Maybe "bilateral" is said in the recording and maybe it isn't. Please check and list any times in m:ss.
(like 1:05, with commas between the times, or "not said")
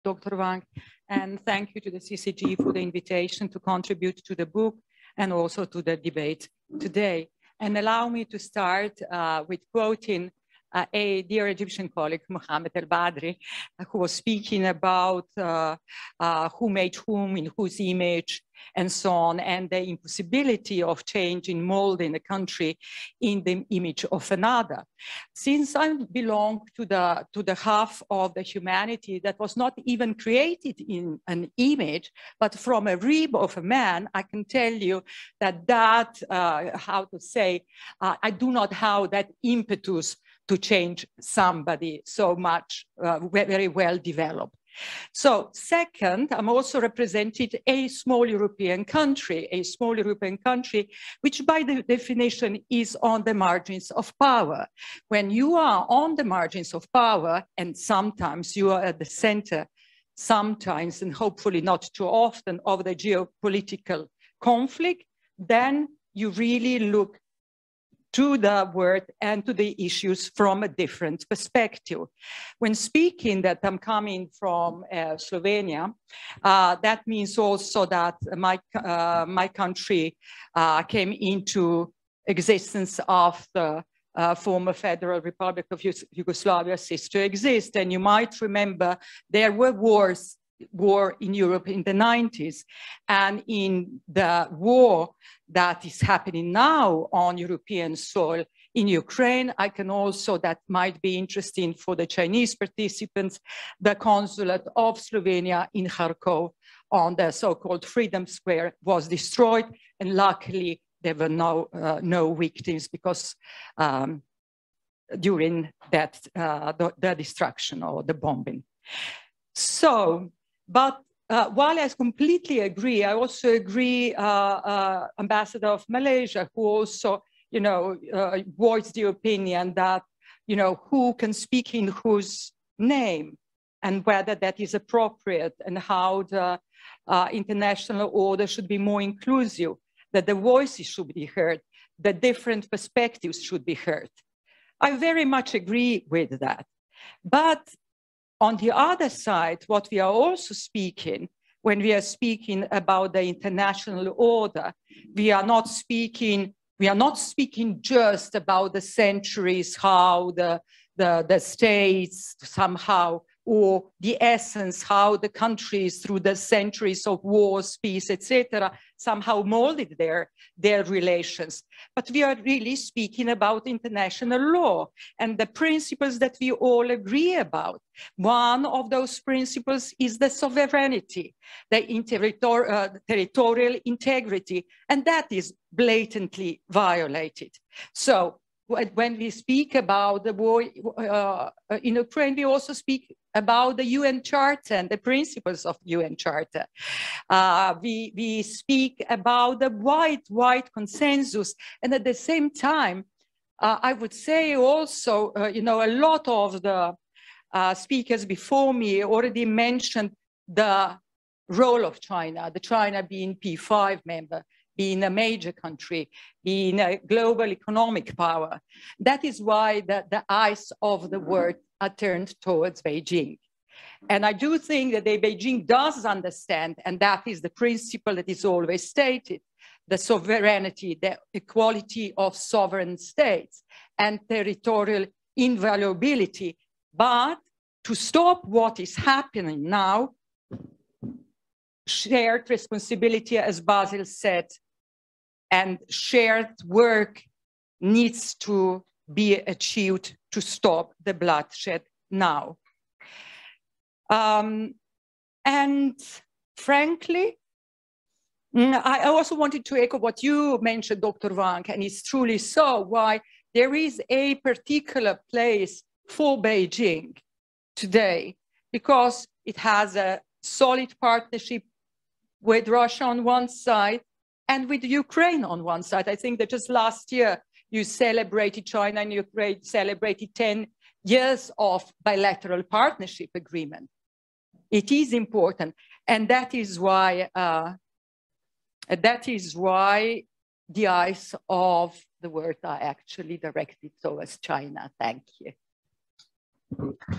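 4:42.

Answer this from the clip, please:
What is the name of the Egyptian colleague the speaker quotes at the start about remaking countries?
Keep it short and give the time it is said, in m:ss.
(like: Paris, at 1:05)
Mohammed El Badri, at 0:12.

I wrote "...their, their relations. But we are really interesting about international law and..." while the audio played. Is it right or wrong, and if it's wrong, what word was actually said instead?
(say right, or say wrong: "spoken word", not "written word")
wrong: "speaking", not "interesting".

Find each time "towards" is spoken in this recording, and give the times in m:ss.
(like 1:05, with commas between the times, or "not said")
3:42, 4:54.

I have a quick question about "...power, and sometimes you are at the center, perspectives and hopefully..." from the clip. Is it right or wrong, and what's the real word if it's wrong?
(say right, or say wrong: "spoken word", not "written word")
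wrong: "sometimes", not "perspectives".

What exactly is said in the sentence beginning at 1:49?
And luckily, there were no, uh, no victims because um, during that, uh, the, the destruction or the bombing.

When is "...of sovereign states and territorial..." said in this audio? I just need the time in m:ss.
3:52.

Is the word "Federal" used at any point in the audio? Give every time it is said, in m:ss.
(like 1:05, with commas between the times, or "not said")
1:24.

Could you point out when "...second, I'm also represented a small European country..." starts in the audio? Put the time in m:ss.
0:45.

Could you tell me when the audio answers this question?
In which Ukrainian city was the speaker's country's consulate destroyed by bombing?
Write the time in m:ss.
1:45.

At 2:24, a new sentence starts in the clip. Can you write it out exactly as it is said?
I very much agree with that.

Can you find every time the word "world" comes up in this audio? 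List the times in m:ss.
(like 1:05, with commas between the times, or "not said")
3:41, 4:52.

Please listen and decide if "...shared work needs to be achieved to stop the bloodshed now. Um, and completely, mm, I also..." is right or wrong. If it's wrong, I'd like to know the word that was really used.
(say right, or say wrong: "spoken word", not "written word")
wrong: "frankly", not "completely".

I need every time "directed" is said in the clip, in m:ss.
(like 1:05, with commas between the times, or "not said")
4:53.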